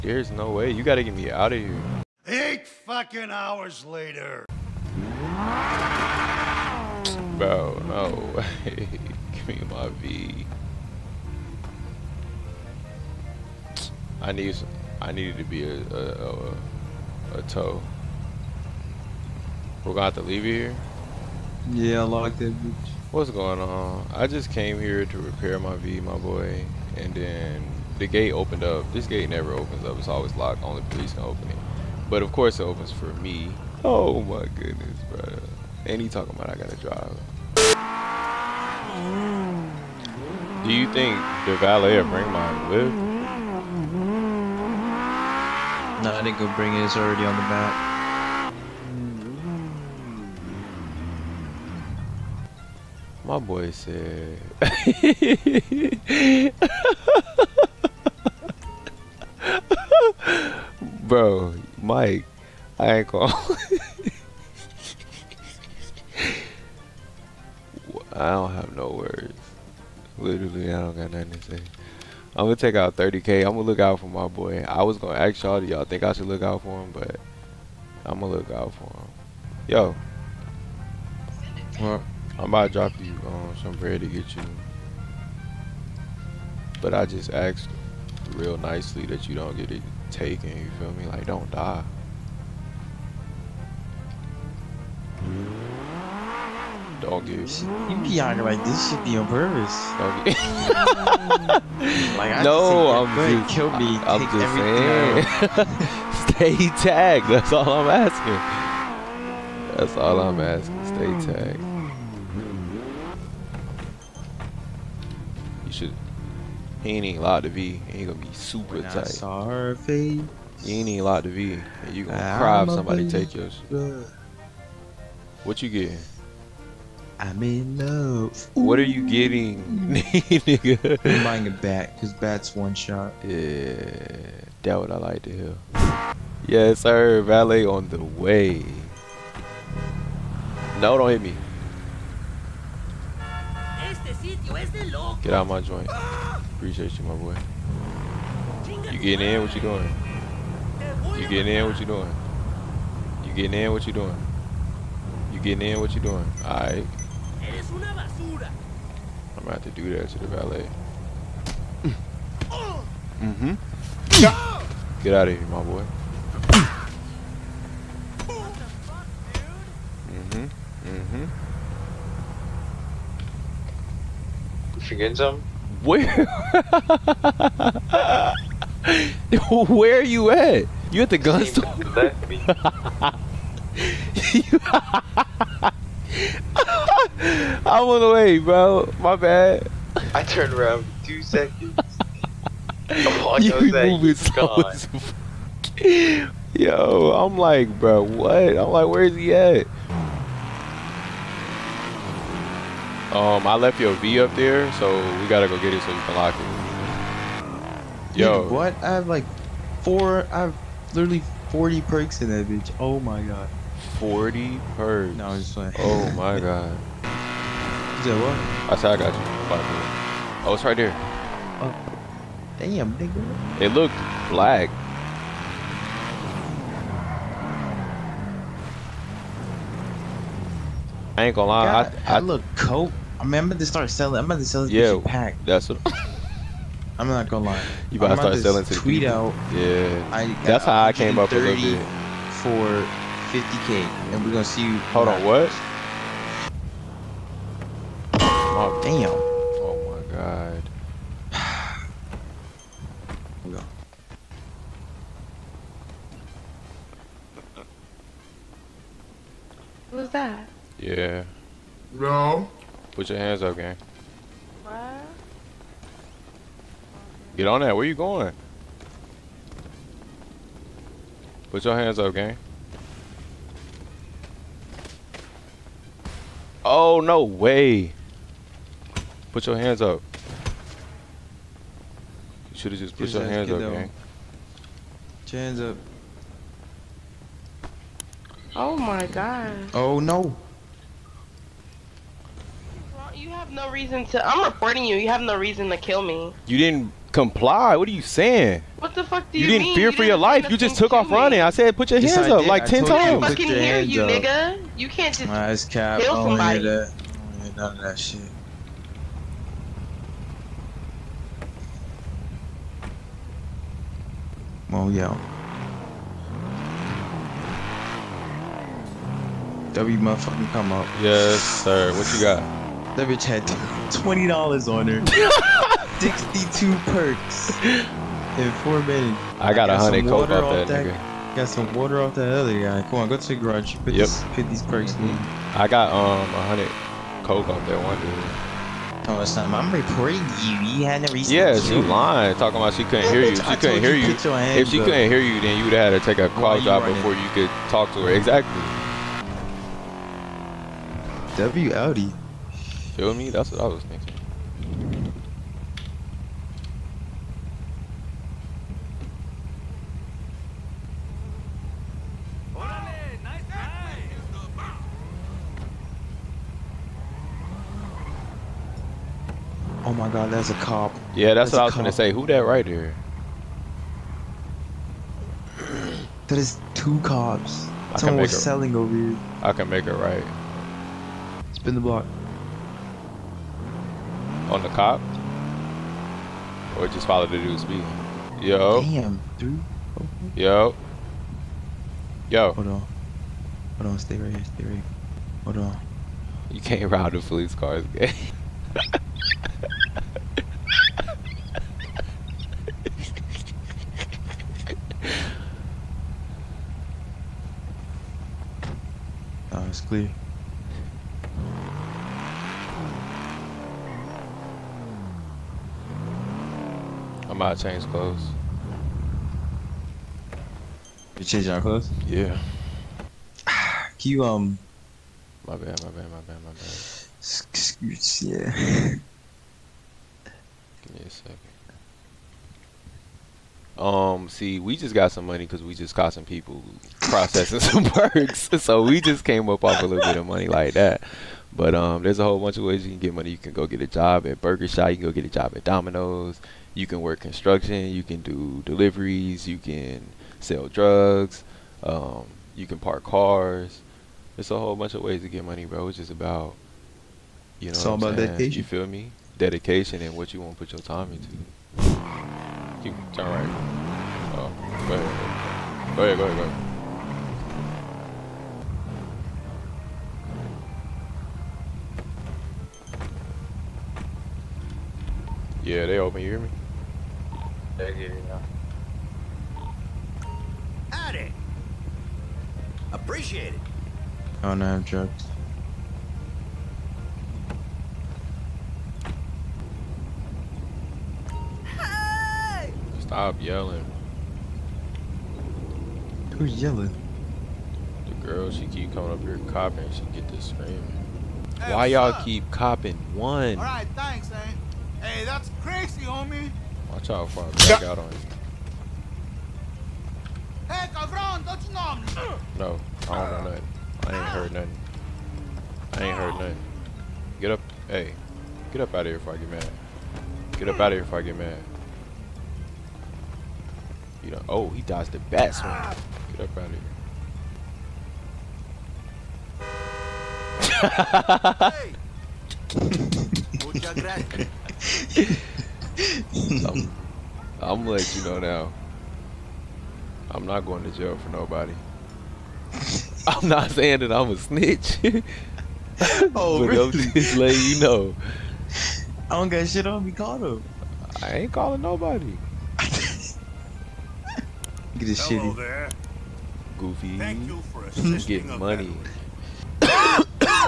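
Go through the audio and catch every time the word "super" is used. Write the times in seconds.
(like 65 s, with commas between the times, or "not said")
118 s.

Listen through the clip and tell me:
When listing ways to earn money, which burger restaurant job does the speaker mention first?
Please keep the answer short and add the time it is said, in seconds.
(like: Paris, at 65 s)
Burger Shot, at 444 s.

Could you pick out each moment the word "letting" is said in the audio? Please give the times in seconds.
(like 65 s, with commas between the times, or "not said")
537 s, 547 s.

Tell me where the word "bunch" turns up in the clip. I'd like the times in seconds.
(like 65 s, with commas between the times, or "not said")
442 s, 454 s.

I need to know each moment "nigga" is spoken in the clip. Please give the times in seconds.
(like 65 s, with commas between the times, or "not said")
129 s, 222 s, 304 s, 330 s.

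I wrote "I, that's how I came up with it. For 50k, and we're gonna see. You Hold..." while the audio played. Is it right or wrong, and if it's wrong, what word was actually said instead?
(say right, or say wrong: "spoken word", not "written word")
right.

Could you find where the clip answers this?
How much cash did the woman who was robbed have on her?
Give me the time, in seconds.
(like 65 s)
323 s.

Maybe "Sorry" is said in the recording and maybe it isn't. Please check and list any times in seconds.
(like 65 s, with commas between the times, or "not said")
119 s.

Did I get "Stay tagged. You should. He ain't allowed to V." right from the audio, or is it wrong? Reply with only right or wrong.
right.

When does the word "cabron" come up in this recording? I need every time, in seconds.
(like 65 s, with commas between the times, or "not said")
510 s.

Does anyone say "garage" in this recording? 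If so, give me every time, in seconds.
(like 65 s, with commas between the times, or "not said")
333 s.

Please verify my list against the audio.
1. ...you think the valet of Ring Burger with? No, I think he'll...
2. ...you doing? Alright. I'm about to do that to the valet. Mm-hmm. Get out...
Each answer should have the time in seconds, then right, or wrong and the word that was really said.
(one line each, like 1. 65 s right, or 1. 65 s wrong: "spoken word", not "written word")
1. 40 s wrong: "Mine", not "Burger"
2. 155 s right.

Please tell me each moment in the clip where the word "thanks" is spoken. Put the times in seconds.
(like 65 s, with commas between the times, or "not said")
503 s, 557 s.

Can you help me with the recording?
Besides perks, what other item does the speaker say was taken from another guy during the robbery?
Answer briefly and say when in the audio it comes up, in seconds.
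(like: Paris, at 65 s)
Water, at 331 s.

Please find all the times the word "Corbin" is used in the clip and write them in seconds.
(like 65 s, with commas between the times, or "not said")
not said.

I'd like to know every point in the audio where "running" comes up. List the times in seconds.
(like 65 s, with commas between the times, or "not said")
301 s, 346 s.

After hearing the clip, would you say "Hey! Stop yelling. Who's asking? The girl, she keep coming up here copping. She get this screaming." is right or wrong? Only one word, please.
wrong.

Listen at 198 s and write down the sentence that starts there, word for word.
I'm like, where is he at?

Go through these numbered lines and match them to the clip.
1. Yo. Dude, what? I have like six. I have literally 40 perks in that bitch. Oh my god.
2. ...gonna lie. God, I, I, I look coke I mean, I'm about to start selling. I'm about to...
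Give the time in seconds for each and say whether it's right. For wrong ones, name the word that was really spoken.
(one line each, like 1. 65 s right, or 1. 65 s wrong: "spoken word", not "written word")
1. 208 s wrong: "four", not "six"
2. 231 s right.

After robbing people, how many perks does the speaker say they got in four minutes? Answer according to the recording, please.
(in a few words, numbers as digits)
62.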